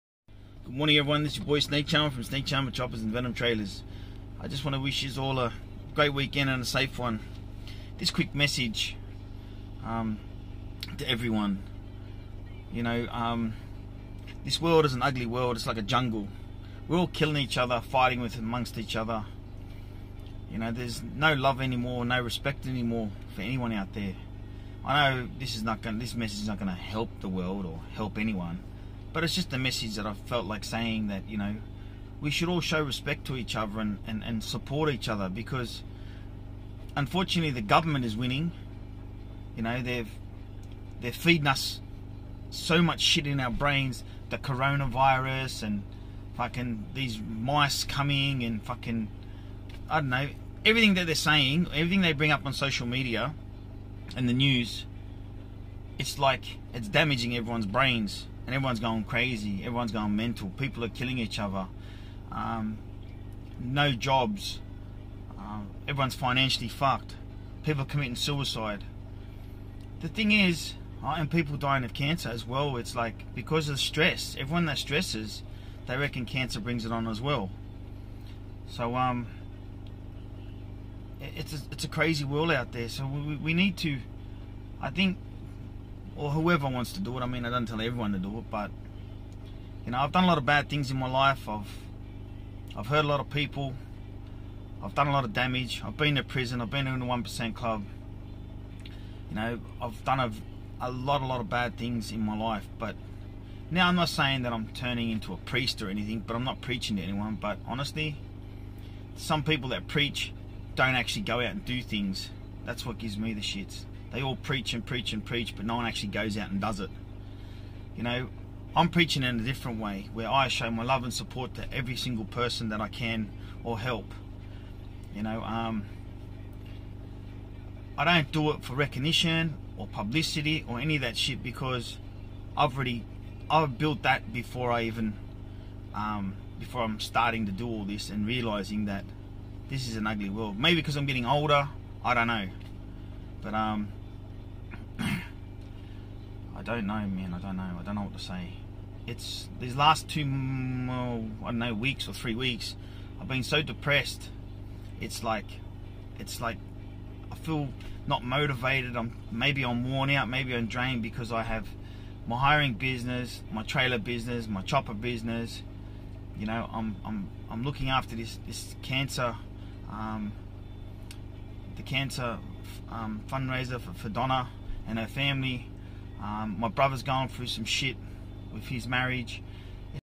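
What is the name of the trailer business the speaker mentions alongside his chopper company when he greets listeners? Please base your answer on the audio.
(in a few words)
Venom Trailers.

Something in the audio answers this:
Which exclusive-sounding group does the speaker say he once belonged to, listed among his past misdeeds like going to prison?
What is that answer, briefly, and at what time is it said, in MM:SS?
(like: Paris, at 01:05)
the one percent club, at 01:37.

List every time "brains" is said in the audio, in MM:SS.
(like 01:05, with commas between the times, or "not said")
00:43, 00:57.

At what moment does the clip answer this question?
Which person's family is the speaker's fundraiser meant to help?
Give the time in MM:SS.
02:54.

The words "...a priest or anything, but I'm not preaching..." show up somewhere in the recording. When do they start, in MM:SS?
01:45.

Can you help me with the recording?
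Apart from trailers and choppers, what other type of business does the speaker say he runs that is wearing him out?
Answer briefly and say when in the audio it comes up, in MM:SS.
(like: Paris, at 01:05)
hiring business, at 02:42.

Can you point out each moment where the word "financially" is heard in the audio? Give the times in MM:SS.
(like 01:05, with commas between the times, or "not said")
01:06.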